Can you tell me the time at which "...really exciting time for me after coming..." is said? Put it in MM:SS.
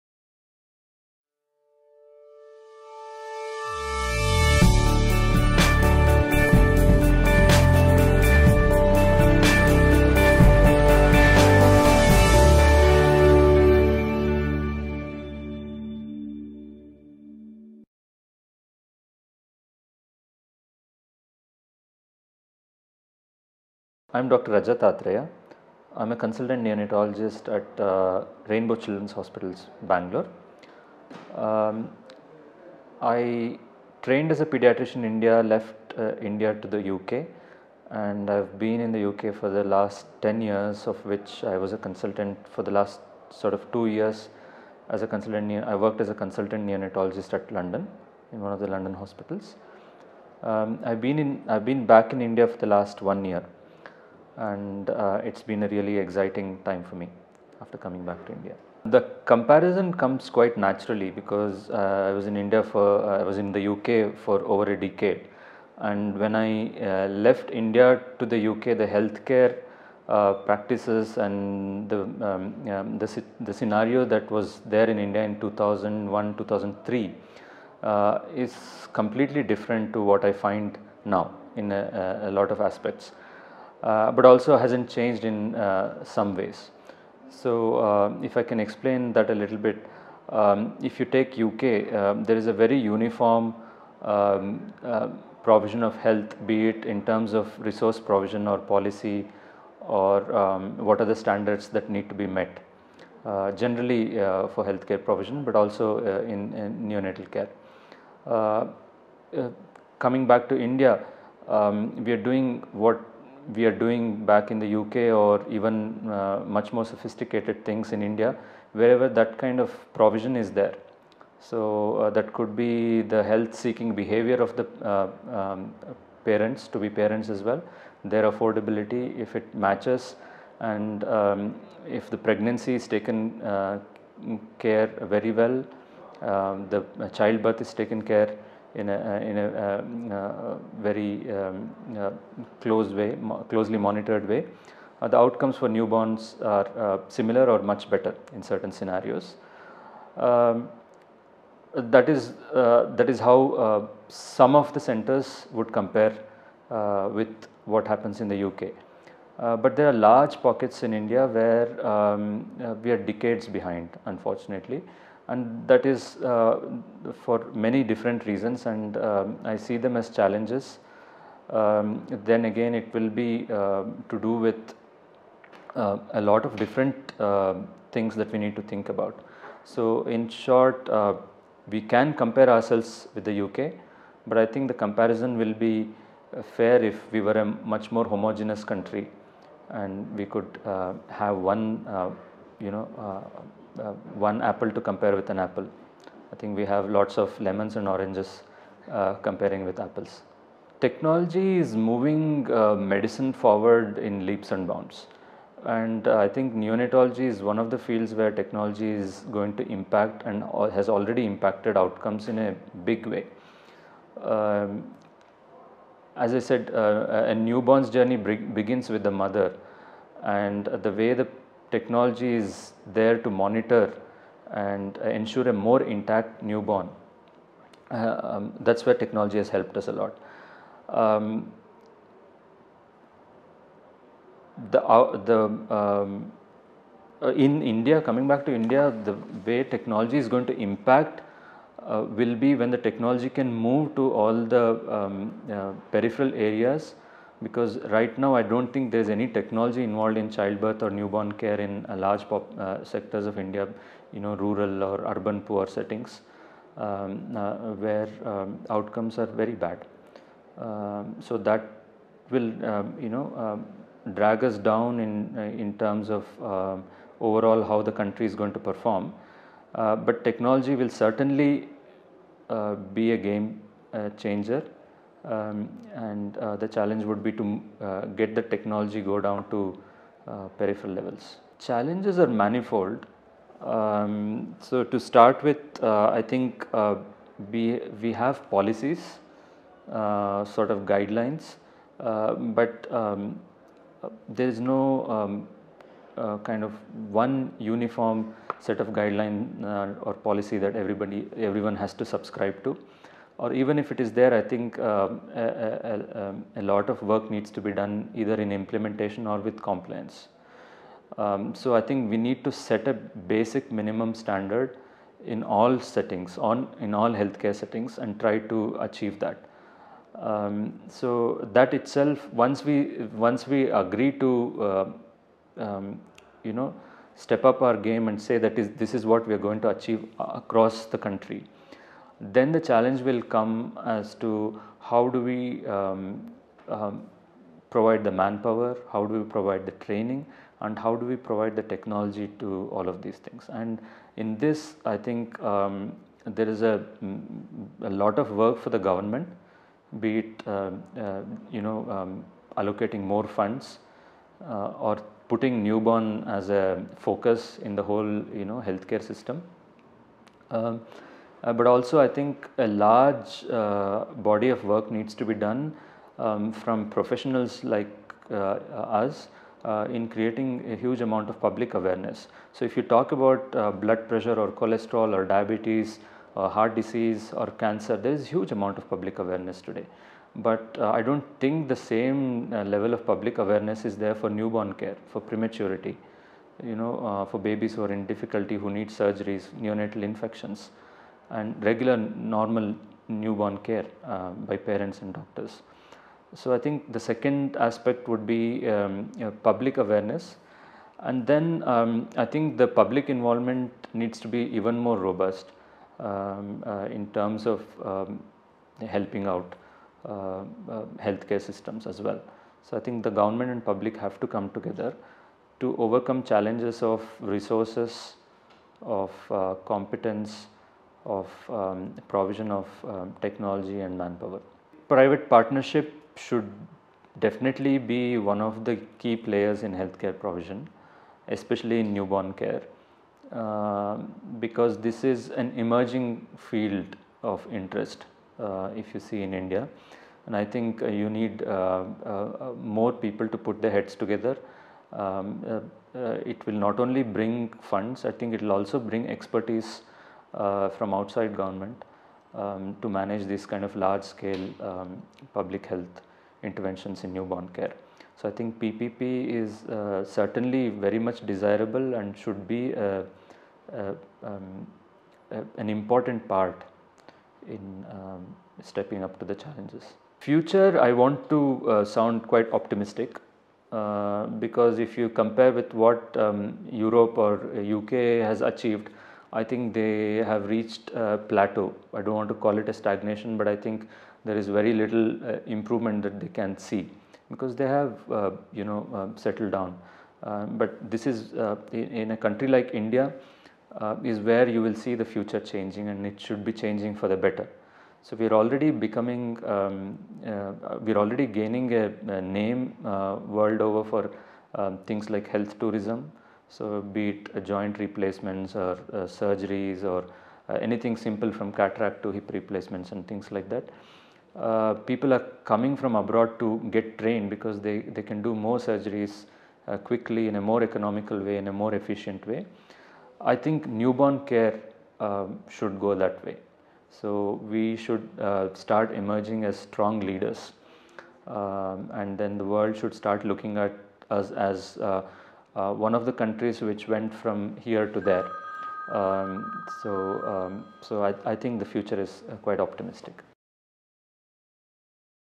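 00:55.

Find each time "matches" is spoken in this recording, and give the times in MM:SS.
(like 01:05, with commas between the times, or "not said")
02:09.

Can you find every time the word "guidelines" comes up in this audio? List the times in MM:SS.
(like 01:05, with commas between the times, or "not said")
04:50, 04:58.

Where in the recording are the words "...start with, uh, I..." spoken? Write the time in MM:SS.
04:44.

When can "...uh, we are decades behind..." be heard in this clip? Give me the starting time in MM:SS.
02:42.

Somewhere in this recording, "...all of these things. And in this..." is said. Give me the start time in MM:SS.
05:42.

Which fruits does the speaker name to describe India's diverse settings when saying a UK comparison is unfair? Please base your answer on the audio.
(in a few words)
Lemons and oranges.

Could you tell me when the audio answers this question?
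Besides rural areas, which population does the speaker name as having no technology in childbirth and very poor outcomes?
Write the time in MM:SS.
04:15.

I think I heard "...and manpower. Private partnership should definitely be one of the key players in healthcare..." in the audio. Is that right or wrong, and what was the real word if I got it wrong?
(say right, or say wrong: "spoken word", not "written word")
right.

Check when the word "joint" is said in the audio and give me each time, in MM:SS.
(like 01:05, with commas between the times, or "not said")
08:27.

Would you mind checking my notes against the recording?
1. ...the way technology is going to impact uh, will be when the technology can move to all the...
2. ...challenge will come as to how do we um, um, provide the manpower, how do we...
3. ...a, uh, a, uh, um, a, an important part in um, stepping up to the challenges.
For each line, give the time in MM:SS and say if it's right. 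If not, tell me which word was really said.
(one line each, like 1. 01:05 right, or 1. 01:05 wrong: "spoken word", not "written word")
1. 03:59 right
2. 05:32 right
3. 07:42 right.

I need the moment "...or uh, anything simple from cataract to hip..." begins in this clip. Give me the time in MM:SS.
08:29.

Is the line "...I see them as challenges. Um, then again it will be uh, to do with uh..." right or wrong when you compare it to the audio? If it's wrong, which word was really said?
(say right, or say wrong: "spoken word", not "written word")
right.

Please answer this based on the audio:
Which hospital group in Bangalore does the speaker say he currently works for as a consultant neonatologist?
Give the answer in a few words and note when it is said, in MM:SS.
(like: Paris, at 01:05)
Rainbow Children's Hospitals, at 00:28.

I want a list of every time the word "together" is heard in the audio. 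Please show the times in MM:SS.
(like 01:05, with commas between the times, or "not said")
06:54, 07:23.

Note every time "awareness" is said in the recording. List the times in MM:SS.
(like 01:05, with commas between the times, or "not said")
06:11, 06:19, 06:23, 06:39.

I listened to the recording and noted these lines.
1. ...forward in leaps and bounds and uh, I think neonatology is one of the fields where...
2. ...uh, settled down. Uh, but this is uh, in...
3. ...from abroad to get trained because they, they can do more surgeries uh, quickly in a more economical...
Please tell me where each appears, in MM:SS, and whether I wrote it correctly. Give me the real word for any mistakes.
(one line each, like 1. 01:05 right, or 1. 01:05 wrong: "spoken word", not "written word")
1. 03:23 right
2. 08:08 right
3. 08:35 right.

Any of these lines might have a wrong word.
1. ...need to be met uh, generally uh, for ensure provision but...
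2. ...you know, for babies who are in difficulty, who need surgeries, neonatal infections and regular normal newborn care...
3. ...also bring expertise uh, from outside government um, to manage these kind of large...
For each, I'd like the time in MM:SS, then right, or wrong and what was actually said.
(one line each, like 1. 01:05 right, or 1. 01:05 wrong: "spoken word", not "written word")
1. 01:41 wrong: "healthcare", not "ensure"
2. 06:26 right
3. 07:28 right.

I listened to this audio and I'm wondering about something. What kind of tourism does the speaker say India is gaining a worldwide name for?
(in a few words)
Health tourism.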